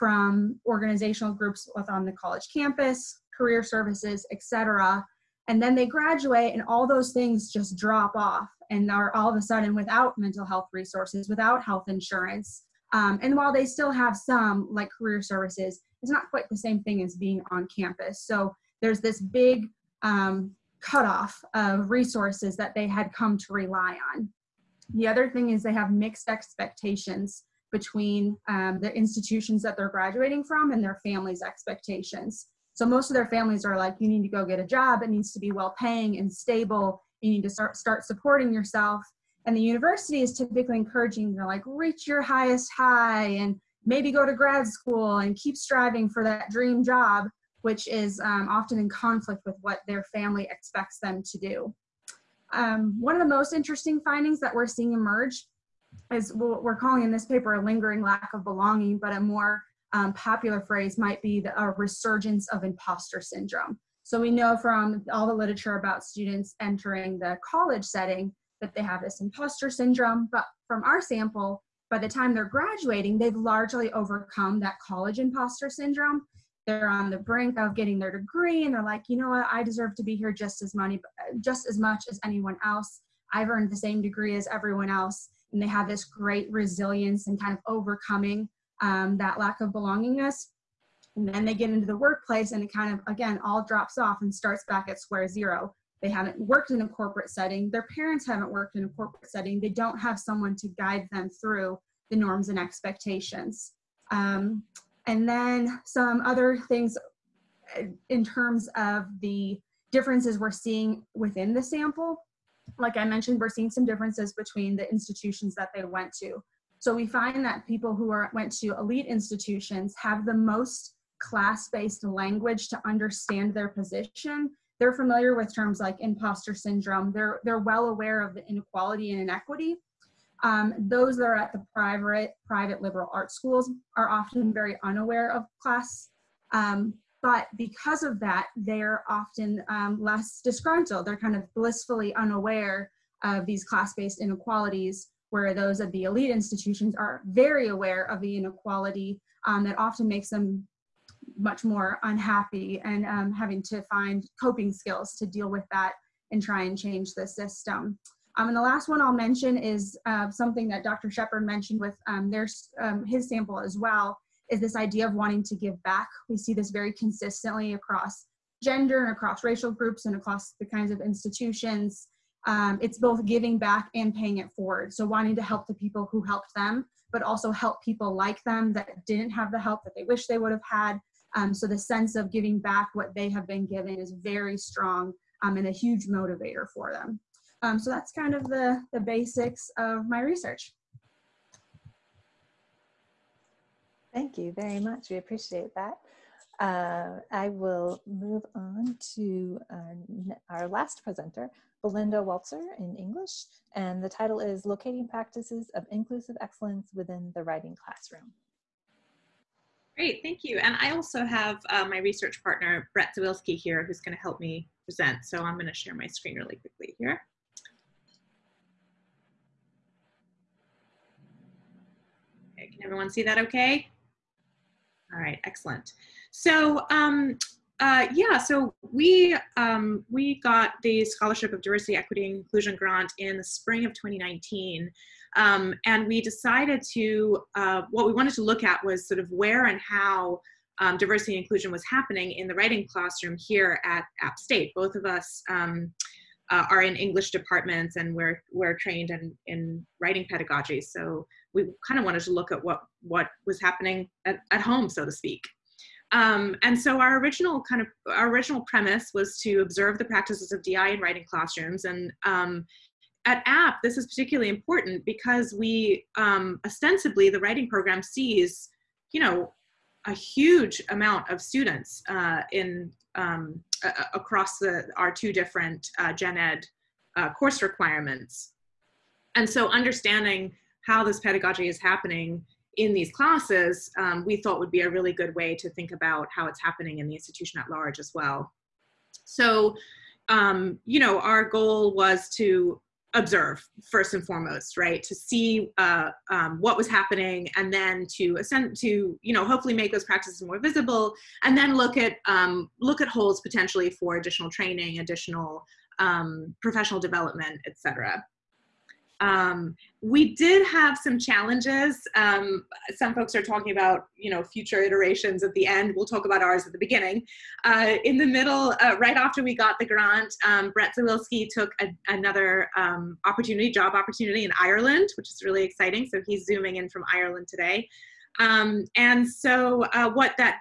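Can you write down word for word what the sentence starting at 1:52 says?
Like I mentioned, we're seeing some differences between the institutions that they went to.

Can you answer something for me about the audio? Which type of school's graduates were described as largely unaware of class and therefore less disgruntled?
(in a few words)
private liberal arts schools.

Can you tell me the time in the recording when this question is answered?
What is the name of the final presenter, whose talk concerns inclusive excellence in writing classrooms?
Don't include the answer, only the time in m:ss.
3:21.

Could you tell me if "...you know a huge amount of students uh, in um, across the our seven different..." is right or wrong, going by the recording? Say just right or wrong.
wrong.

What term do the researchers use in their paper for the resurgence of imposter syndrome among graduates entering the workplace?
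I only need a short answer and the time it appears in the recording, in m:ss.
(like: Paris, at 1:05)
lingering lack of belonging, at 0:57.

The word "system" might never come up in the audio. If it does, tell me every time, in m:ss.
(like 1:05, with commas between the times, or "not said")
2:37.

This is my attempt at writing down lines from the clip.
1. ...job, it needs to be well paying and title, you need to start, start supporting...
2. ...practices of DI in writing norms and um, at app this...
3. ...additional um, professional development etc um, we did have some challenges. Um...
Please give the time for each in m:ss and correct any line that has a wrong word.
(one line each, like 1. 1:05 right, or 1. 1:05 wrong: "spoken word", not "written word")
1. 0:34 wrong: "stable", not "title"
2. 4:20 wrong: "classrooms", not "norms"
3. 5:04 right.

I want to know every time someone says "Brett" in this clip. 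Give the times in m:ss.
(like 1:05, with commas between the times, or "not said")
3:32, 5:20.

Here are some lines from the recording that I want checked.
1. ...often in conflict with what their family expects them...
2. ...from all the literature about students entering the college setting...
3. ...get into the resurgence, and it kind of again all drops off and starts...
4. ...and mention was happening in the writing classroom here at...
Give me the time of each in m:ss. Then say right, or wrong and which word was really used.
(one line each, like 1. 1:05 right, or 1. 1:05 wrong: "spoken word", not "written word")
1. 0:48 right
2. 1:04 right
3. 1:31 wrong: "workplace", not "resurgence"
4. 4:01 wrong: "inclusion", not "mention".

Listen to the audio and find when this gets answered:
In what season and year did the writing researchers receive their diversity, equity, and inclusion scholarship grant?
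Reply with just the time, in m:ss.
3:53.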